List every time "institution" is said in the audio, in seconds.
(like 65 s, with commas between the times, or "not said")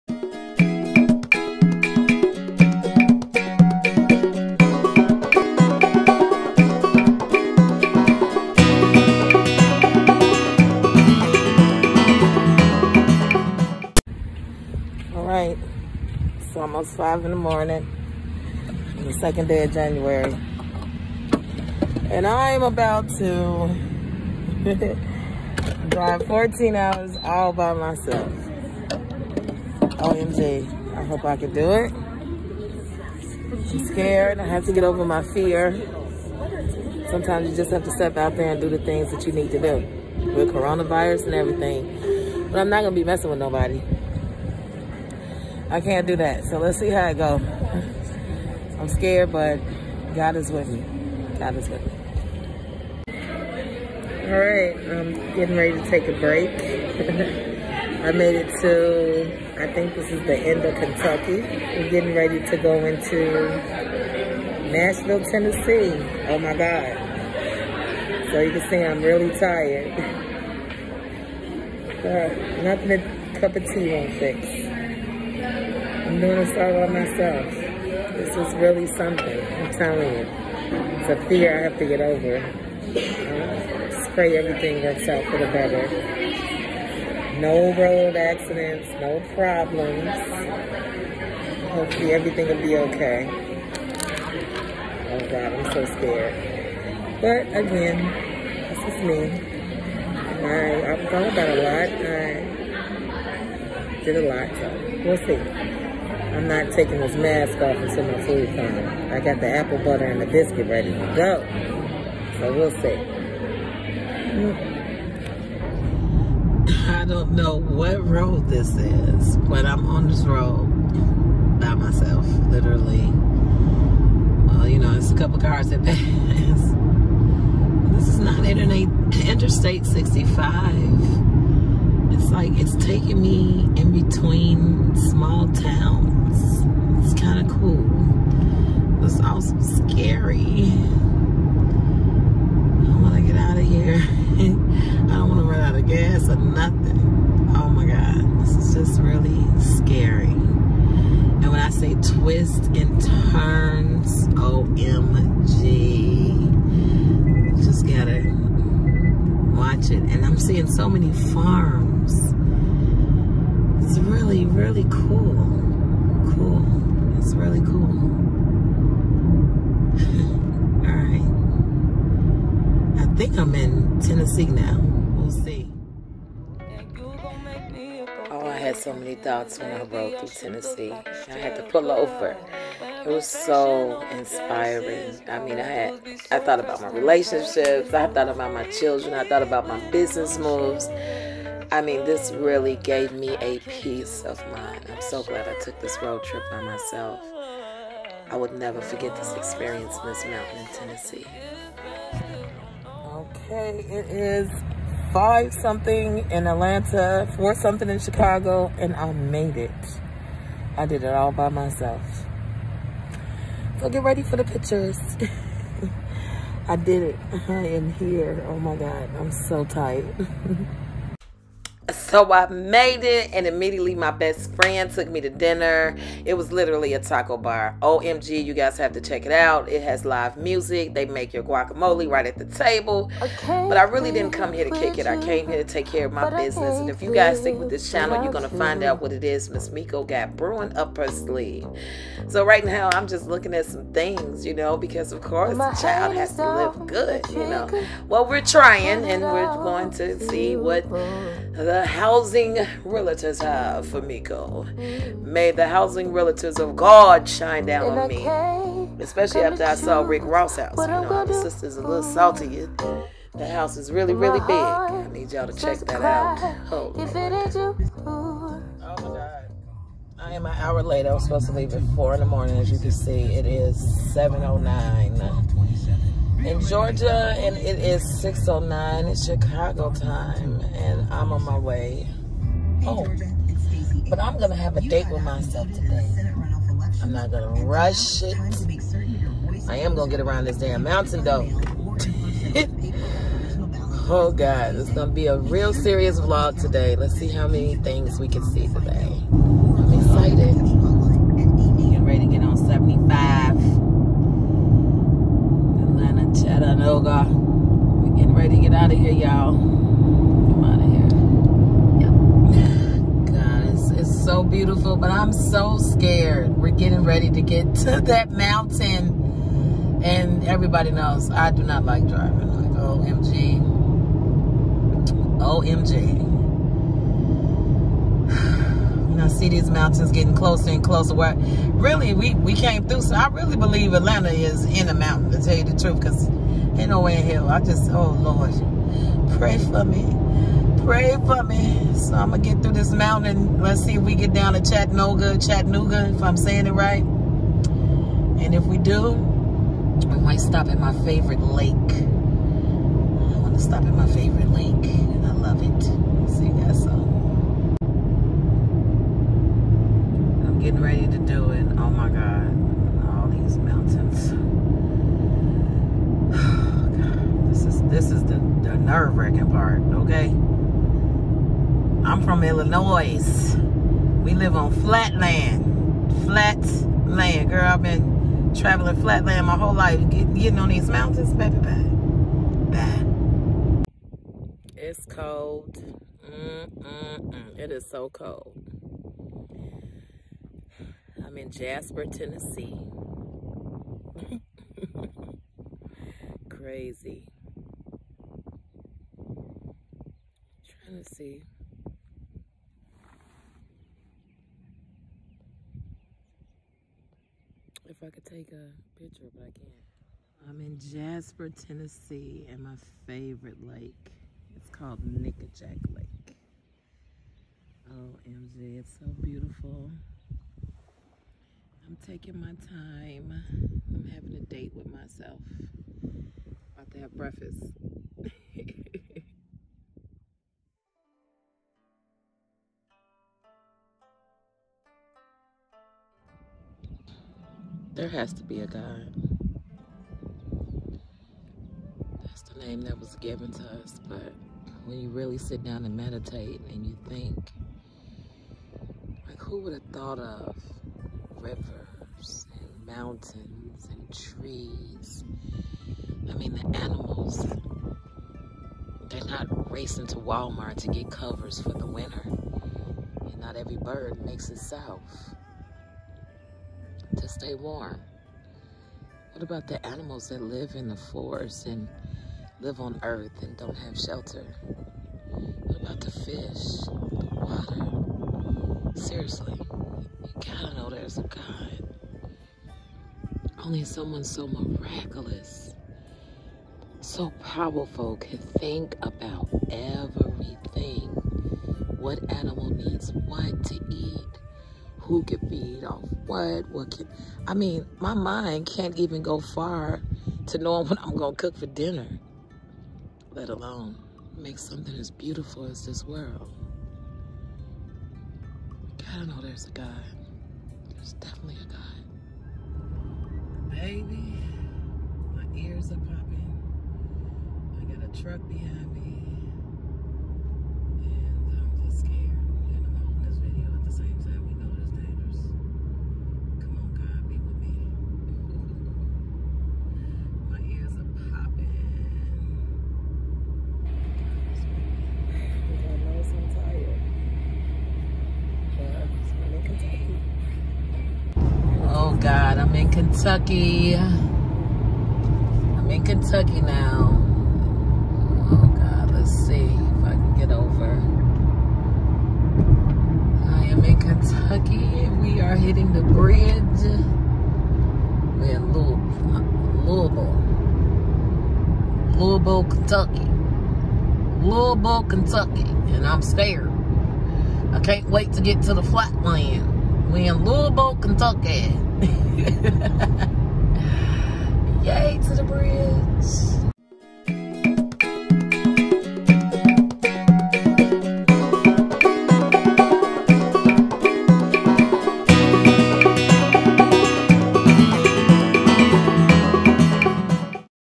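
not said.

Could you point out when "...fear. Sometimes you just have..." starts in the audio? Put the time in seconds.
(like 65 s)
35 s.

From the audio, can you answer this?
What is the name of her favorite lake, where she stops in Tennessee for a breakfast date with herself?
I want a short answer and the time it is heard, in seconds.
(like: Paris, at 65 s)
Nickajack Lake, at 415 s.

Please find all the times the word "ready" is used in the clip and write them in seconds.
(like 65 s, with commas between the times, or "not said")
55 s, 62 s, 110 s, 214 s, 302 s, 308 s, 317 s, 360 s.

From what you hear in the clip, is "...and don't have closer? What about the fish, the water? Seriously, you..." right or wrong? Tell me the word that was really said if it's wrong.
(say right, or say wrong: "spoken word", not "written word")
wrong: "shelter", not "closer".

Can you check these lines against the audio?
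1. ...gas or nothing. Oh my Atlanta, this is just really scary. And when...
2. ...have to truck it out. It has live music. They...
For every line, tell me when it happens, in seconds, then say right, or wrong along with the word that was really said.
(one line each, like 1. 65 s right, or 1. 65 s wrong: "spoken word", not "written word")
1. 145 s wrong: "God", not "Atlanta"
2. 228 s wrong: "check", not "truck".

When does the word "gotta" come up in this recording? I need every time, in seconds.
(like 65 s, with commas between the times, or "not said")
157 s, 480 s, 508 s.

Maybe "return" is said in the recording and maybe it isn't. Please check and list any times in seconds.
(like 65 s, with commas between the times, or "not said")
not said.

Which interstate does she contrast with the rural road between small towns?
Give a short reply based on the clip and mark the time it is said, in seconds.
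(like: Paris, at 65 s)
Interstate 65, at 128 s.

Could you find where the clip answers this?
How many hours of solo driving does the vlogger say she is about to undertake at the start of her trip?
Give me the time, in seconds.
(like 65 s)
26 s.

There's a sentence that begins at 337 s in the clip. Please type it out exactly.
I just, oh Lord, pray for me.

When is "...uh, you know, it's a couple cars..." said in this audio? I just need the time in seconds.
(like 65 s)
124 s.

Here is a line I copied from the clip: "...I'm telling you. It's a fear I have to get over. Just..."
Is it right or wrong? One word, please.
right.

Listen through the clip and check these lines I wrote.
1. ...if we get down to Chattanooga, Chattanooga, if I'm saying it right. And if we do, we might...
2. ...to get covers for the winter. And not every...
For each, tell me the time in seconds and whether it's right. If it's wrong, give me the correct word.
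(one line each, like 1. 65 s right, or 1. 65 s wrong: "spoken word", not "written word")
1. 343 s right
2. 460 s right.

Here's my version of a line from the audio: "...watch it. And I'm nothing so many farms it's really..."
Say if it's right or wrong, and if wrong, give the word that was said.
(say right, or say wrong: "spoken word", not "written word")
wrong: "seeing", not "nothing".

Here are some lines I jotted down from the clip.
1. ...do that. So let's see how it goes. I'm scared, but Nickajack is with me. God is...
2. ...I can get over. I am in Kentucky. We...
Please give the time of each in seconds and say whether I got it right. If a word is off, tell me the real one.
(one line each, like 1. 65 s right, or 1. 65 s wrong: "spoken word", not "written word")
1. 46 s wrong: "God", not "Nickajack"
2. 550 s right.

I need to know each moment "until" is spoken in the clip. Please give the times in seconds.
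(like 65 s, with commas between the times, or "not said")
107 s.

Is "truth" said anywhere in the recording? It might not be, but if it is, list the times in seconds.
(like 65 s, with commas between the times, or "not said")
335 s.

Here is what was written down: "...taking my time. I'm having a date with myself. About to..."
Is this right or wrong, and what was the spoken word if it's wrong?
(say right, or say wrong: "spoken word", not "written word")
right.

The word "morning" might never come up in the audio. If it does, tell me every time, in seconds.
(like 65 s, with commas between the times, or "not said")
17 s, 272 s.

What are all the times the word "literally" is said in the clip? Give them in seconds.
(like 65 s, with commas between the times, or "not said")
122 s, 226 s.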